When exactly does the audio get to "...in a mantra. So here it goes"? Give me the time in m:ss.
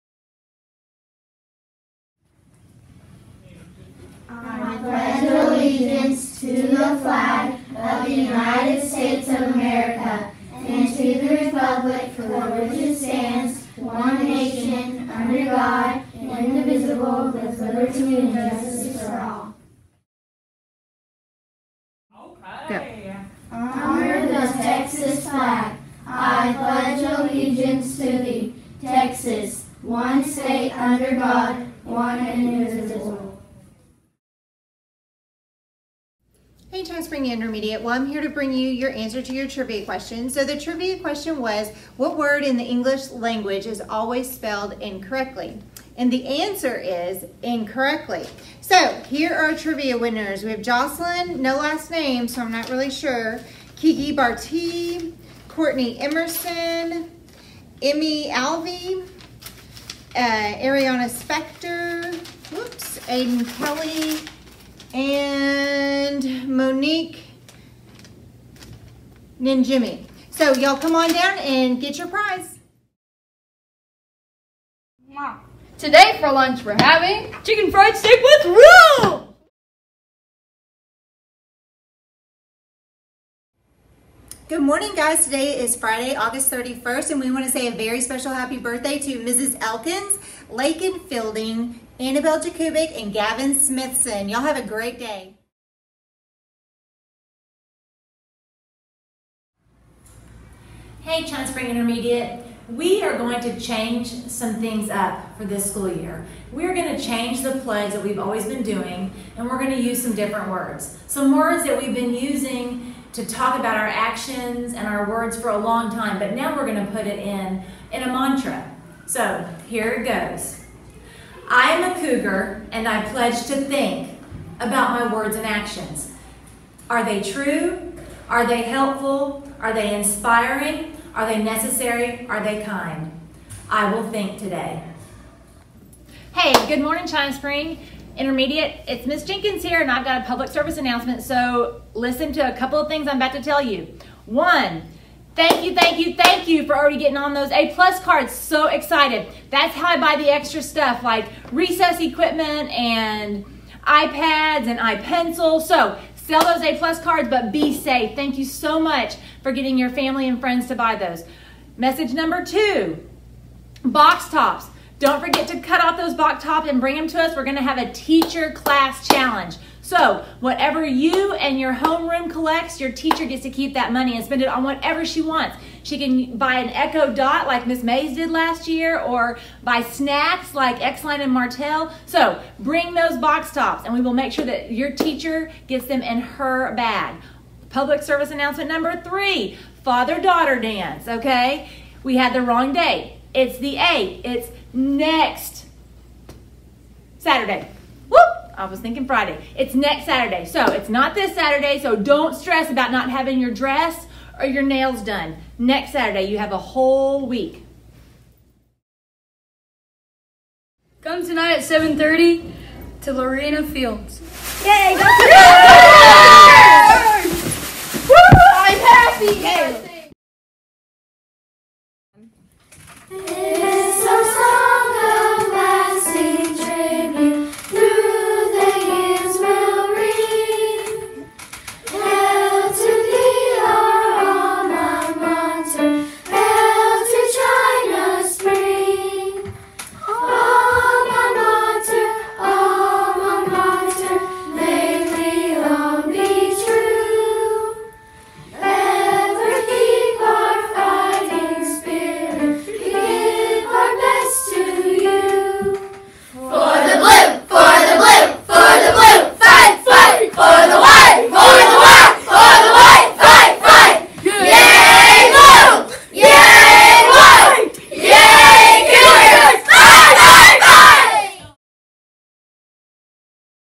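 1:57.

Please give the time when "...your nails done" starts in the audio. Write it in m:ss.
3:24.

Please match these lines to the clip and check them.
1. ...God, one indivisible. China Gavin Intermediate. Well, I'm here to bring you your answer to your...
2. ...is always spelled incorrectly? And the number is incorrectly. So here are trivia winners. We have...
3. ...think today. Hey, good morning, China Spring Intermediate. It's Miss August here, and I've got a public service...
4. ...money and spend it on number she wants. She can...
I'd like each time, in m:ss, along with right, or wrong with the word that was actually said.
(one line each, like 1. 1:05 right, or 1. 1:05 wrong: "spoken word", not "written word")
1. 0:31 wrong: "Spring", not "Gavin"
2. 0:43 wrong: "answer", not "number"
3. 2:14 wrong: "Jenkins", not "August"
4. 2:53 wrong: "whatever", not "number".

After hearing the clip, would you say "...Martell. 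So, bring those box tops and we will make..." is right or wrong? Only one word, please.
right.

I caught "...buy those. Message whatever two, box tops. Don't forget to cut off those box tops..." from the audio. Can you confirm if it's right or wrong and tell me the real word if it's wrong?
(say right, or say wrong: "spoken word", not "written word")
wrong: "number", not "whatever".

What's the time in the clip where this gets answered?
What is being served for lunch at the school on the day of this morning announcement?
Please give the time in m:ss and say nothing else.
1:17.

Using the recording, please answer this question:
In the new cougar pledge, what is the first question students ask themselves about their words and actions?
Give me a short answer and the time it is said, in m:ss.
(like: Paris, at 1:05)
Are they true?, at 2:06.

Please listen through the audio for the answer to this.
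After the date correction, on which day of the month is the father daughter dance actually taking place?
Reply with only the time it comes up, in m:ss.
3:13.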